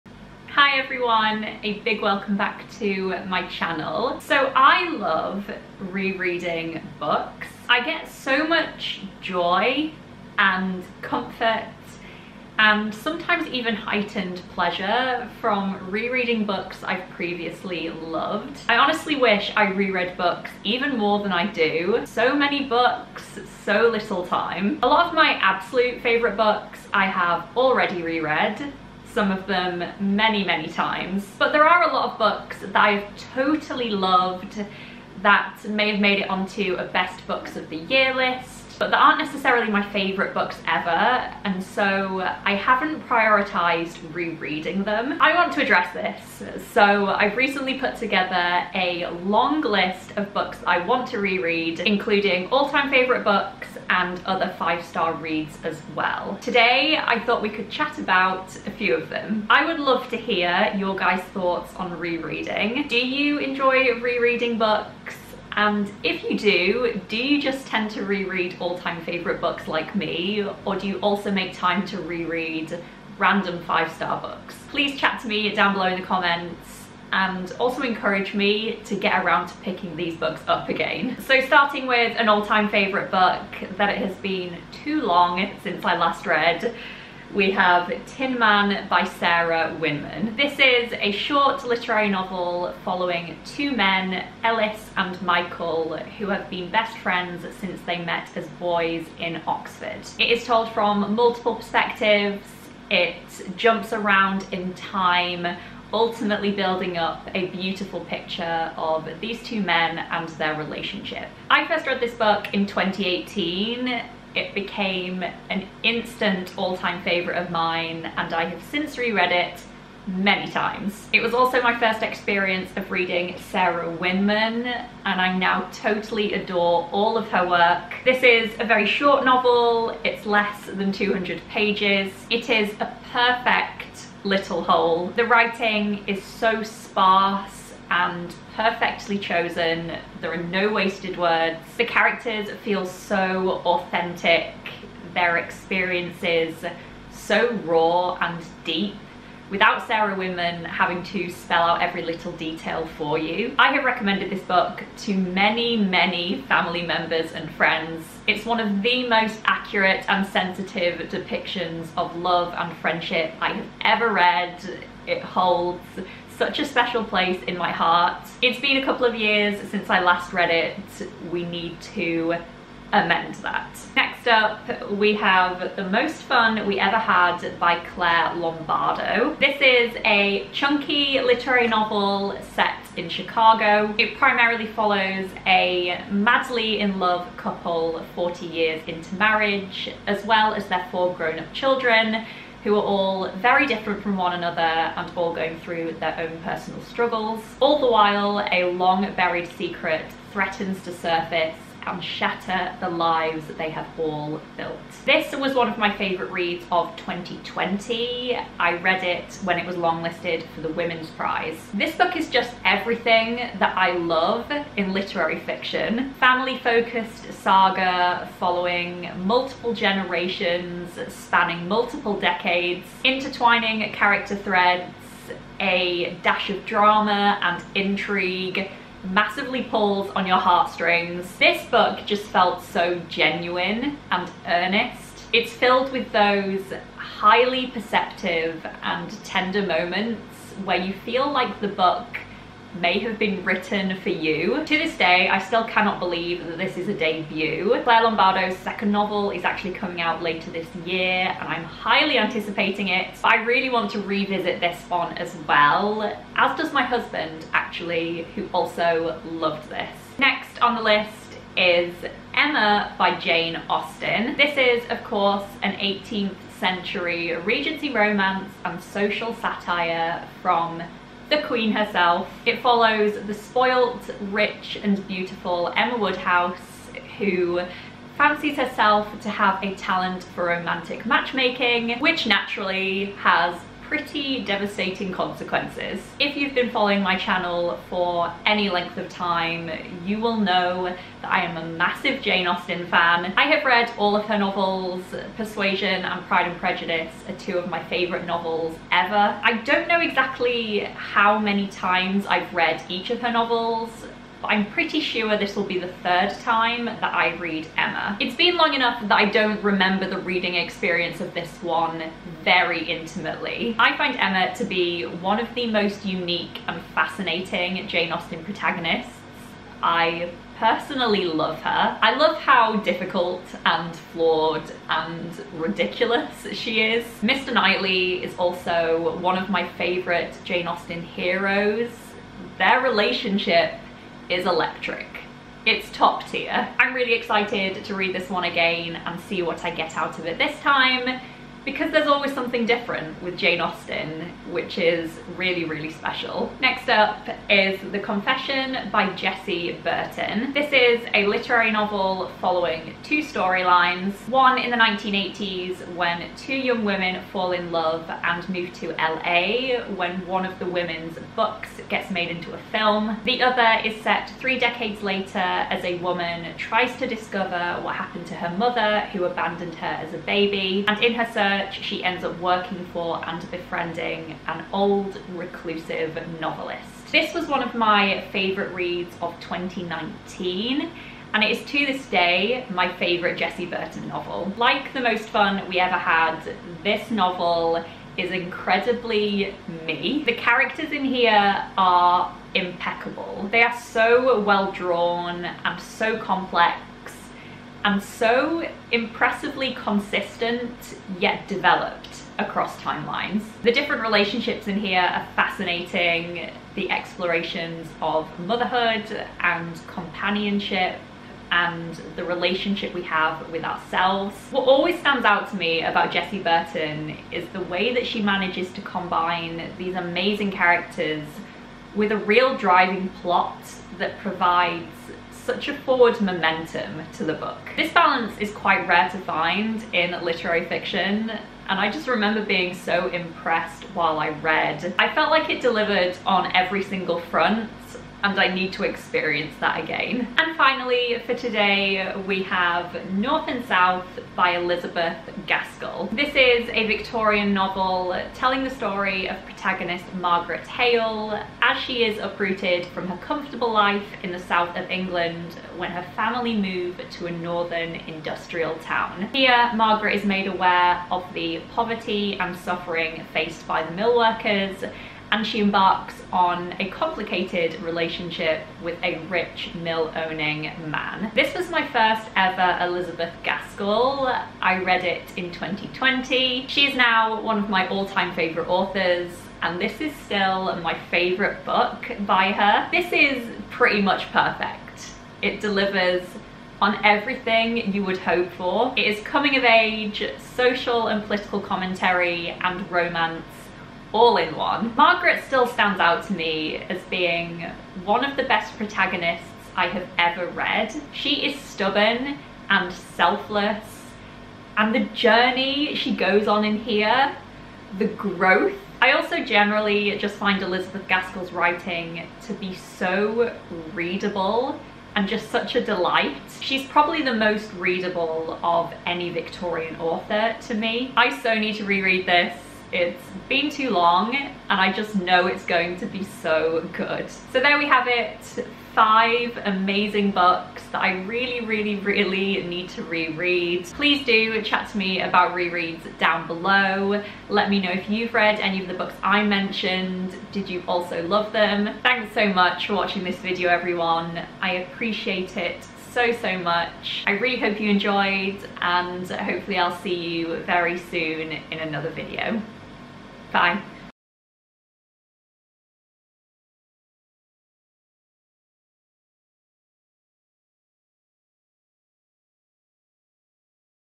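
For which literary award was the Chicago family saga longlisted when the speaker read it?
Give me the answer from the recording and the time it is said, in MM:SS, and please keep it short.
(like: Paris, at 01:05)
Women's Prize, at 03:30.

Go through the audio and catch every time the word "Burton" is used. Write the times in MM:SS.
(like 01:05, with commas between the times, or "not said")
05:49, 06:23, 06:56.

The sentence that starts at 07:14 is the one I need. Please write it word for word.
I felt like it delivered on every single front and I need to experience that again.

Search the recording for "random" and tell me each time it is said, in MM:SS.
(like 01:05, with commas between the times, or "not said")
01:13.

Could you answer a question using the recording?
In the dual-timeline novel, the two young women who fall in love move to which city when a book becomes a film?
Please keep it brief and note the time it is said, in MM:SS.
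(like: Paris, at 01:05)
LA, at 05:58.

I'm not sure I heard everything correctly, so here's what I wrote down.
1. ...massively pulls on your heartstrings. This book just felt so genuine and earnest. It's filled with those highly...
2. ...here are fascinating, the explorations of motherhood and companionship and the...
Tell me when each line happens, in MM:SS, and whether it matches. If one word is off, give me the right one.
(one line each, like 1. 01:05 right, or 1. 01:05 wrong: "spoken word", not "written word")
1. 03:49 right
2. 06:44 right.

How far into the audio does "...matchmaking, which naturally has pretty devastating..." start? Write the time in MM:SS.
04:41.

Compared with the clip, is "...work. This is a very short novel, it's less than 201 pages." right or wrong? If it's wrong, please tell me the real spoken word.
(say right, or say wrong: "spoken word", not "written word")
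wrong: "200", not "201".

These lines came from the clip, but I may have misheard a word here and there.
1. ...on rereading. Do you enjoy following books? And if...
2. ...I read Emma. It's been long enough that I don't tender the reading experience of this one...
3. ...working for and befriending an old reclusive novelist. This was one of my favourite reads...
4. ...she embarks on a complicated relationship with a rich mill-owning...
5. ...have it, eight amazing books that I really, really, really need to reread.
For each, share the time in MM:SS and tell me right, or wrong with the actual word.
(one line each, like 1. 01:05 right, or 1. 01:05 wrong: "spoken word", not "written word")
1. 01:01 wrong: "rereading", not "following"
2. 05:07 wrong: "remember", not "tender"
3. 06:12 right
4. 07:45 right
5. 08:47 wrong: "five", not "eight".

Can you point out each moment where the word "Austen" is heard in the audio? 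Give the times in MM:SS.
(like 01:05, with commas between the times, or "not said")
04:23, 04:52, 05:18, 05:30, 05:43.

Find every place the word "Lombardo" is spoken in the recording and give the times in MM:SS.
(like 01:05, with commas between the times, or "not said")
02:58, 04:08.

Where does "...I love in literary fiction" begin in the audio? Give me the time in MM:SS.
03:33.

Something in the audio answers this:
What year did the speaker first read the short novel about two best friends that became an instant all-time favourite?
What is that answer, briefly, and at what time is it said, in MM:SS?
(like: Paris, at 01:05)
2018, at 01:52.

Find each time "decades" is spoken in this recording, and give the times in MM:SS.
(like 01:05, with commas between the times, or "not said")
03:42, 06:04.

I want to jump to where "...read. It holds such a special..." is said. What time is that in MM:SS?
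02:44.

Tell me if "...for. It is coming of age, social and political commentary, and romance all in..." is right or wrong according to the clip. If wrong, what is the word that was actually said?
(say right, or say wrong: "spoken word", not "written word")
right.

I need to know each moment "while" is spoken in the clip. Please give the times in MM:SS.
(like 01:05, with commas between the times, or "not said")
03:17, 07:13.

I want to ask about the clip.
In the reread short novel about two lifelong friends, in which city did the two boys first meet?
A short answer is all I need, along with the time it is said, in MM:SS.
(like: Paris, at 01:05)
Oxford, at 01:39.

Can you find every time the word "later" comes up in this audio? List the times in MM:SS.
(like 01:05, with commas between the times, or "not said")
04:10, 06:05.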